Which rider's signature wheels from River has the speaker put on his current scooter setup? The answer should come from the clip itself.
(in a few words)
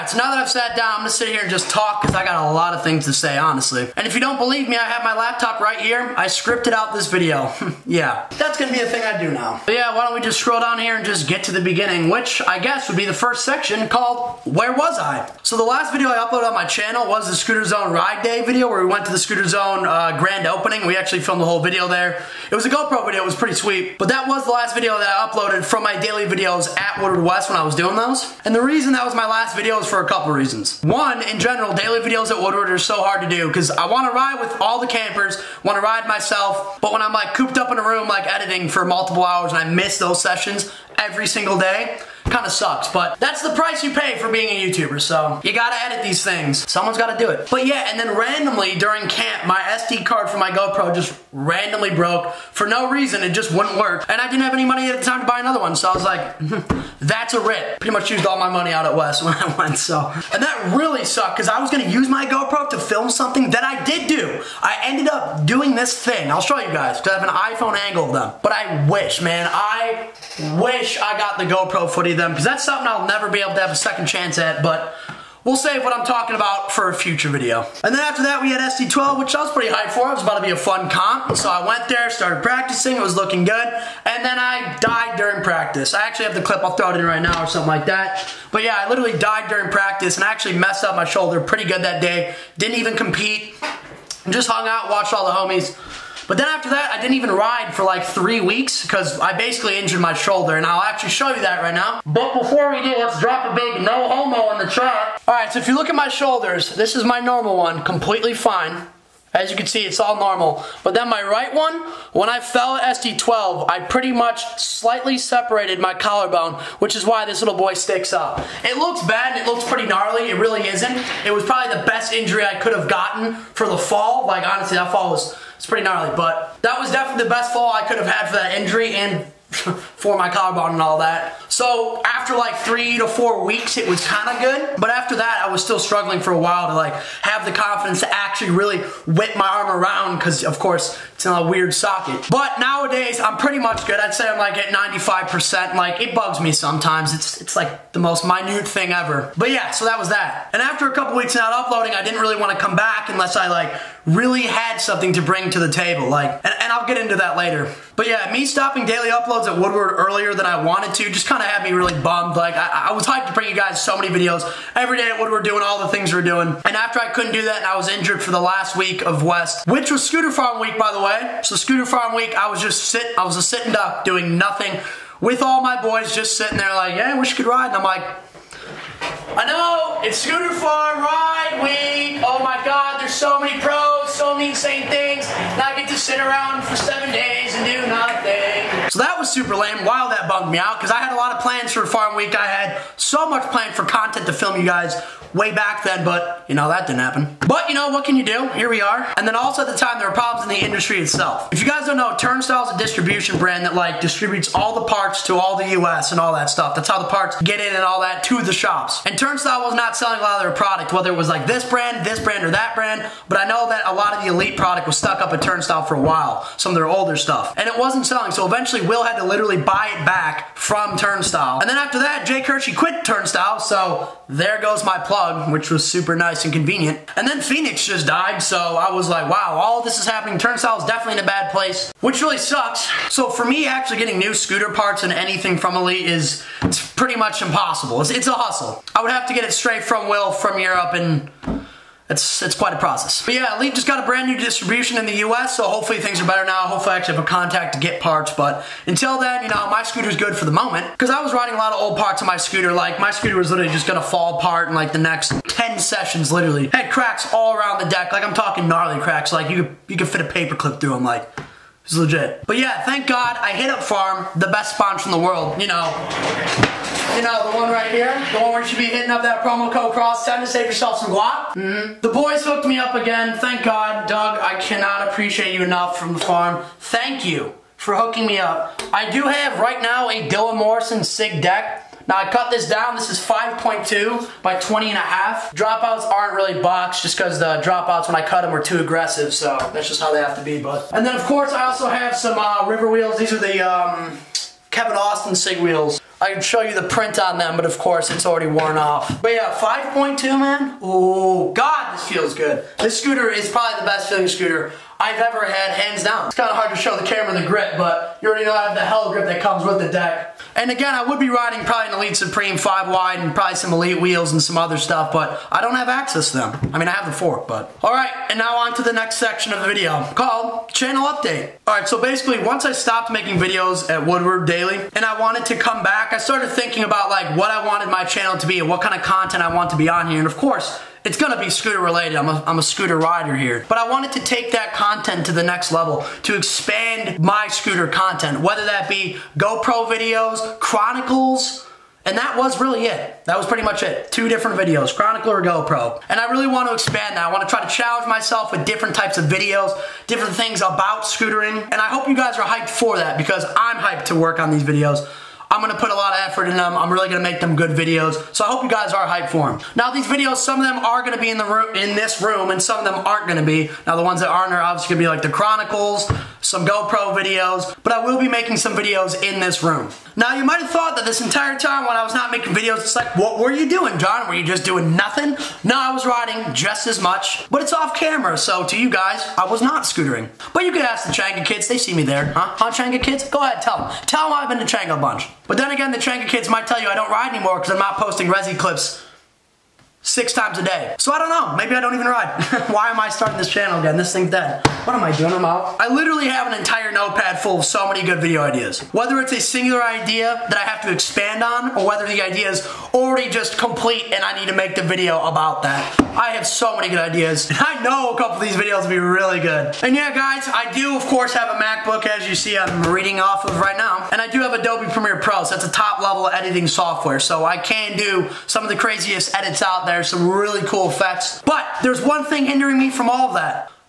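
Kevin Austin.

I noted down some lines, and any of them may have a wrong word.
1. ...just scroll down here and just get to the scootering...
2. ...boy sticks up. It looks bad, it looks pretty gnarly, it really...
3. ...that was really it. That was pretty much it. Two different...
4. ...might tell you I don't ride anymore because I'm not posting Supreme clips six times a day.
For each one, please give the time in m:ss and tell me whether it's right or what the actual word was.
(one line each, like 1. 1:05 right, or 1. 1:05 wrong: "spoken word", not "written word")
1. 0:10 wrong: "beginning", not "scootering"
2. 1:57 right
3. 5:42 right
4. 6:26 wrong: "Resi", not "Supreme".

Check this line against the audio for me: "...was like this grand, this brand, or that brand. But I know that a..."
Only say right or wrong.
wrong.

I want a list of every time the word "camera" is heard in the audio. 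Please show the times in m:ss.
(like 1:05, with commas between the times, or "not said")
5:07, 6:17.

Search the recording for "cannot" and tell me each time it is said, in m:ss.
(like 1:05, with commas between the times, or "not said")
4:34.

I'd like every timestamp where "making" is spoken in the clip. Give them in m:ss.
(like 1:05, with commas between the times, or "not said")
5:23, 6:08, 6:12.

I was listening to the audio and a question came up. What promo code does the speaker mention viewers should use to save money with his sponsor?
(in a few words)
cross 10.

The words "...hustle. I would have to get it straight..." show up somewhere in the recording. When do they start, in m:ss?
3:58.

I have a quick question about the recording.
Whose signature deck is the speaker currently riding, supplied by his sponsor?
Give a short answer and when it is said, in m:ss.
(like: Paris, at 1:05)
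Dylan Morrison, at 4:40.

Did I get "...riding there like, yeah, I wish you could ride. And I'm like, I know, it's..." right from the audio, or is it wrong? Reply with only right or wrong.
wrong.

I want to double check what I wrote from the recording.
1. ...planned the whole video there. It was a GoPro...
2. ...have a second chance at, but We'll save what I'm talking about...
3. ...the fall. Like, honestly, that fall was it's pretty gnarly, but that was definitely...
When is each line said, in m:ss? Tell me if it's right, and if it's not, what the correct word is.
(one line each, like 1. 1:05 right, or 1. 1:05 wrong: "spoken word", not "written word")
1. 0:21 wrong: "filmed", not "planned"
2. 1:13 right
3. 2:03 right.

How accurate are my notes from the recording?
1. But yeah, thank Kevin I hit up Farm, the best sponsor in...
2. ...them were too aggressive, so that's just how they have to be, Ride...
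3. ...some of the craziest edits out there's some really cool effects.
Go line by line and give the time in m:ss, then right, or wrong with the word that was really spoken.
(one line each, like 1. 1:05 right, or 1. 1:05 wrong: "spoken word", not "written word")
1. 4:22 wrong: "God", not "Kevin"
2. 4:48 wrong: "But", not "Ride"
3. 6:58 right.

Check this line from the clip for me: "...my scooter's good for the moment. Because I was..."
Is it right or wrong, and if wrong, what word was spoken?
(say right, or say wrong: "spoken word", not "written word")
right.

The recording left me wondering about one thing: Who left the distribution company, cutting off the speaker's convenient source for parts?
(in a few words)
Jay Hershey.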